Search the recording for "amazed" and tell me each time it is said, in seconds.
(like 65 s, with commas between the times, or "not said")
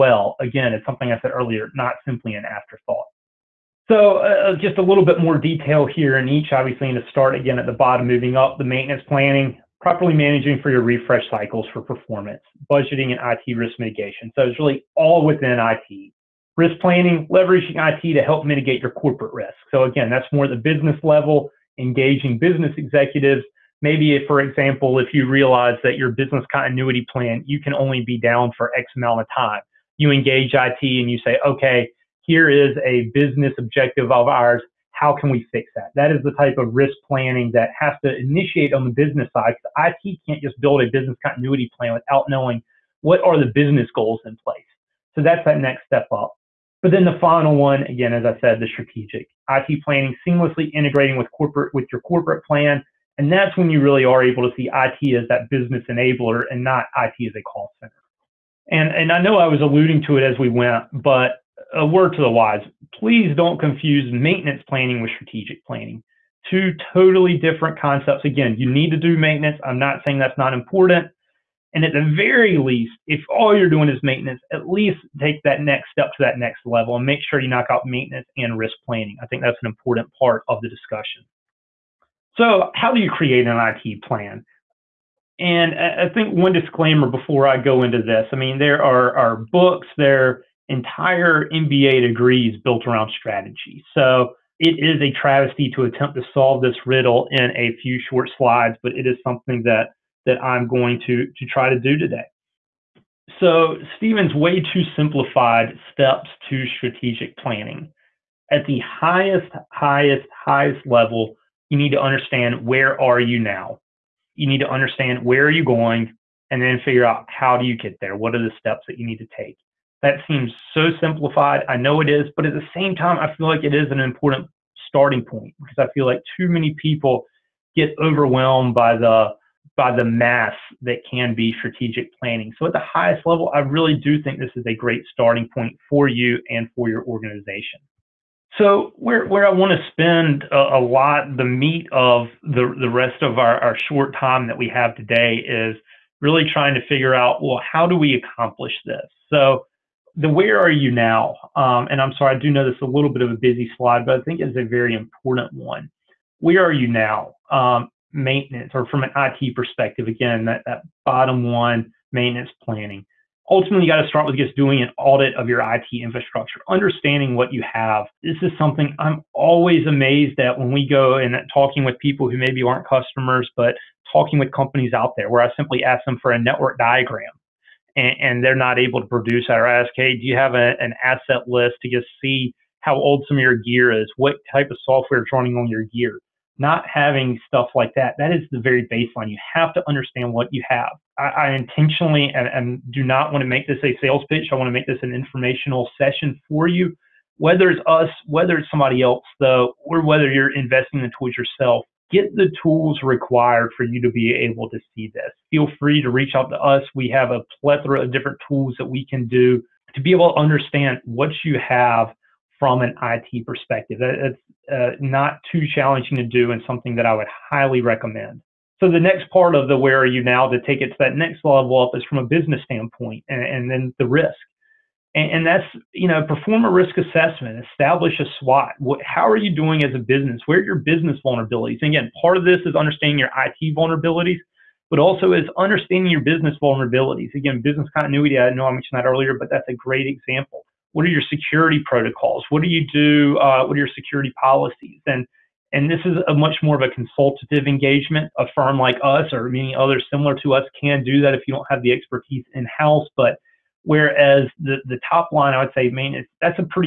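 169 s.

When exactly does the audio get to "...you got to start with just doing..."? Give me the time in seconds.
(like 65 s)
163 s.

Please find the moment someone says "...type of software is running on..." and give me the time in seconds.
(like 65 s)
184 s.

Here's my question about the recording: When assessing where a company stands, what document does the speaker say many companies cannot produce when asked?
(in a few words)
network diagram.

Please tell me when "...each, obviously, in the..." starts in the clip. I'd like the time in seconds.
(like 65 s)
6 s.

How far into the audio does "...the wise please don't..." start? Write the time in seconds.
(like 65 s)
62 s.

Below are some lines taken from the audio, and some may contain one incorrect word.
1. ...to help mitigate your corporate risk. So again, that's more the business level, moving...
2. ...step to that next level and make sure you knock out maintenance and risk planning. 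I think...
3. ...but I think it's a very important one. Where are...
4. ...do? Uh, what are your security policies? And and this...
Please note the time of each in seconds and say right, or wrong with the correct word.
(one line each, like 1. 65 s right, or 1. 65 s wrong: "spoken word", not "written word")
1. 18 s wrong: "engaging", not "moving"
2. 75 s right
3. 154 s right
4. 242 s right.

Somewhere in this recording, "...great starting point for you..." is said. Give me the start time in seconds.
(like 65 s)
134 s.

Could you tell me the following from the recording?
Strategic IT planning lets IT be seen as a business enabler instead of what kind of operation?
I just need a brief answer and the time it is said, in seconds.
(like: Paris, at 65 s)
a call center, at 57 s.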